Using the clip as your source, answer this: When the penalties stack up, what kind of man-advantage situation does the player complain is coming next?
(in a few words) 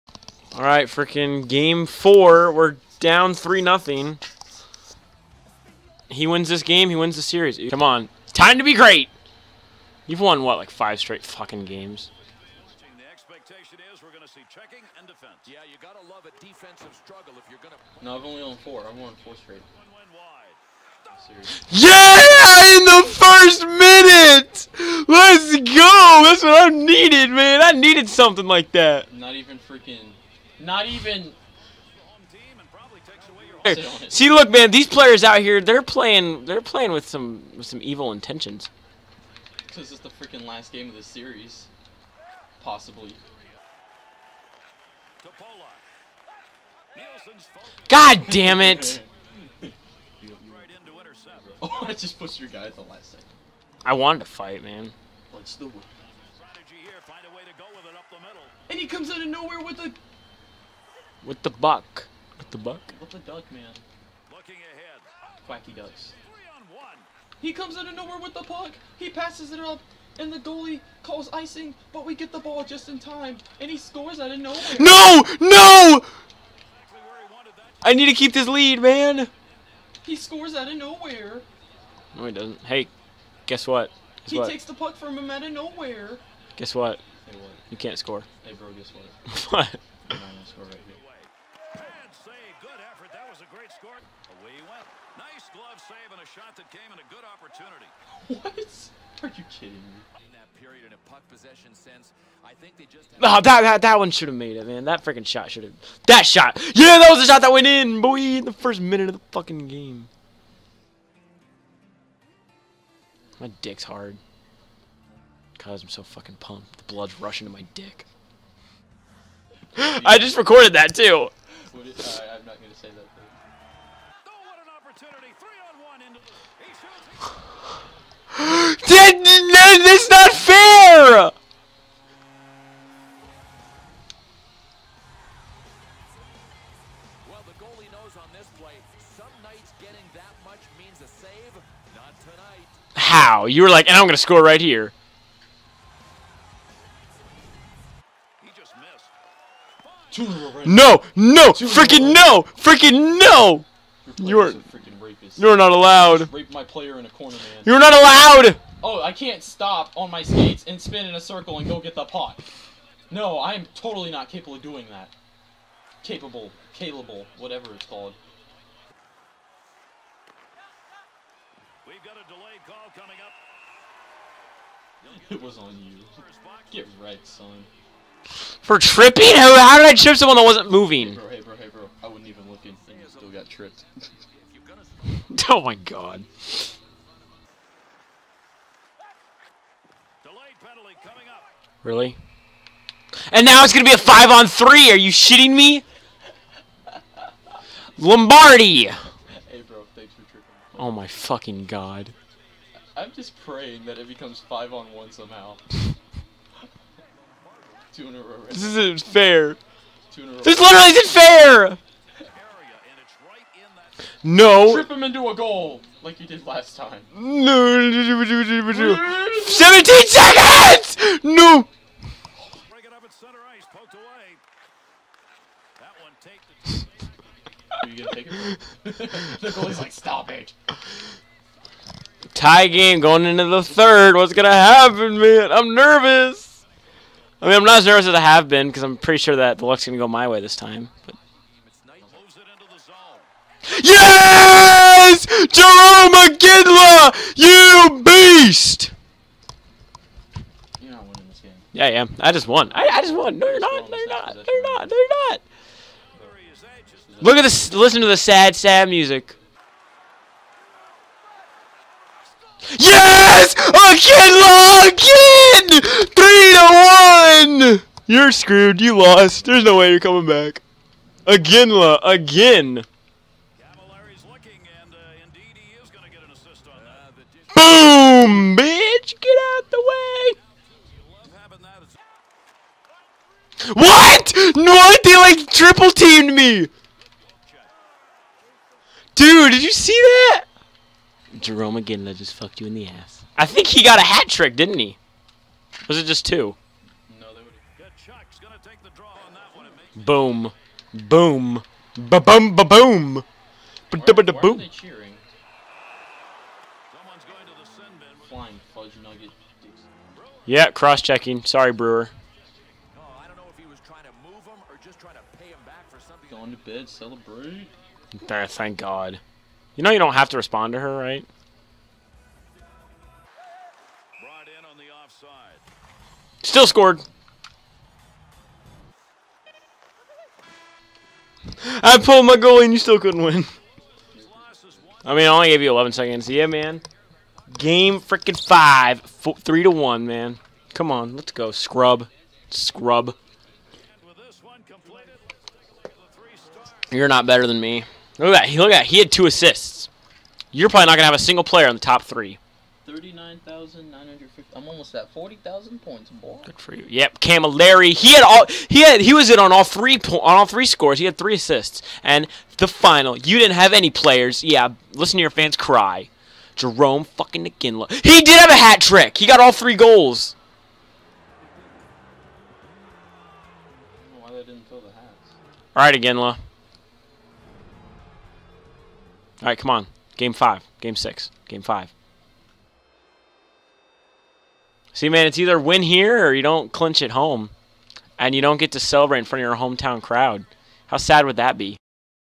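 Five on three.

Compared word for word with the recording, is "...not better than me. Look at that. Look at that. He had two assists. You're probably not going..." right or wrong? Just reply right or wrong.
right.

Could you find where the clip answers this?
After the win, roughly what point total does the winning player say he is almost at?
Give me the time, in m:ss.
5:54.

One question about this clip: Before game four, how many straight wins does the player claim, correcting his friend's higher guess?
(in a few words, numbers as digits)
4.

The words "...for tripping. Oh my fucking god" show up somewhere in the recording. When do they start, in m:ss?
3:20.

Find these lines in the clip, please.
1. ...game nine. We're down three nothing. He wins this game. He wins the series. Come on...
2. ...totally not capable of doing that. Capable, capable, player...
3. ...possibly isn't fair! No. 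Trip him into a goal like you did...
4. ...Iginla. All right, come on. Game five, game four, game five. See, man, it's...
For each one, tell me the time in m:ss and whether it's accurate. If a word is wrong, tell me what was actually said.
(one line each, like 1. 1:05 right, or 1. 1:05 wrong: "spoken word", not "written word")
1. 0:01 wrong: "four", not "nine"
2. 2:43 wrong: "whatever", not "player"
3. 3:30 wrong: "literally", not "possibly"
4. 6:15 wrong: "six", not "four".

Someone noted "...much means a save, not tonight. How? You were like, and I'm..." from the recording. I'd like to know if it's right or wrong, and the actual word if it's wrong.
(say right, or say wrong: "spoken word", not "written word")
right.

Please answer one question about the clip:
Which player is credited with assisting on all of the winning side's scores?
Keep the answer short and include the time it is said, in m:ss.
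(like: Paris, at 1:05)
Camilleri, at 5:57.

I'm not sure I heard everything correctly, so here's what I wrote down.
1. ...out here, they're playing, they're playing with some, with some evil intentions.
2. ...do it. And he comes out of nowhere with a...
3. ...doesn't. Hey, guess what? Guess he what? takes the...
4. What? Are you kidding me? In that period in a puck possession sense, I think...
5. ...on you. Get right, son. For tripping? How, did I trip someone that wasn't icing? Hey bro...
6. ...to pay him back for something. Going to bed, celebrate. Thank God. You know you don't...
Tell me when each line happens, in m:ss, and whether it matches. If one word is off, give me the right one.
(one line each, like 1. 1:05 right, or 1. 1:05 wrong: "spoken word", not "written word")
1. 0:35 right
2. 0:55 right
3. 1:22 right
4. 1:38 right
5. 2:55 wrong: "moving", not "icing"
6. 5:15 right.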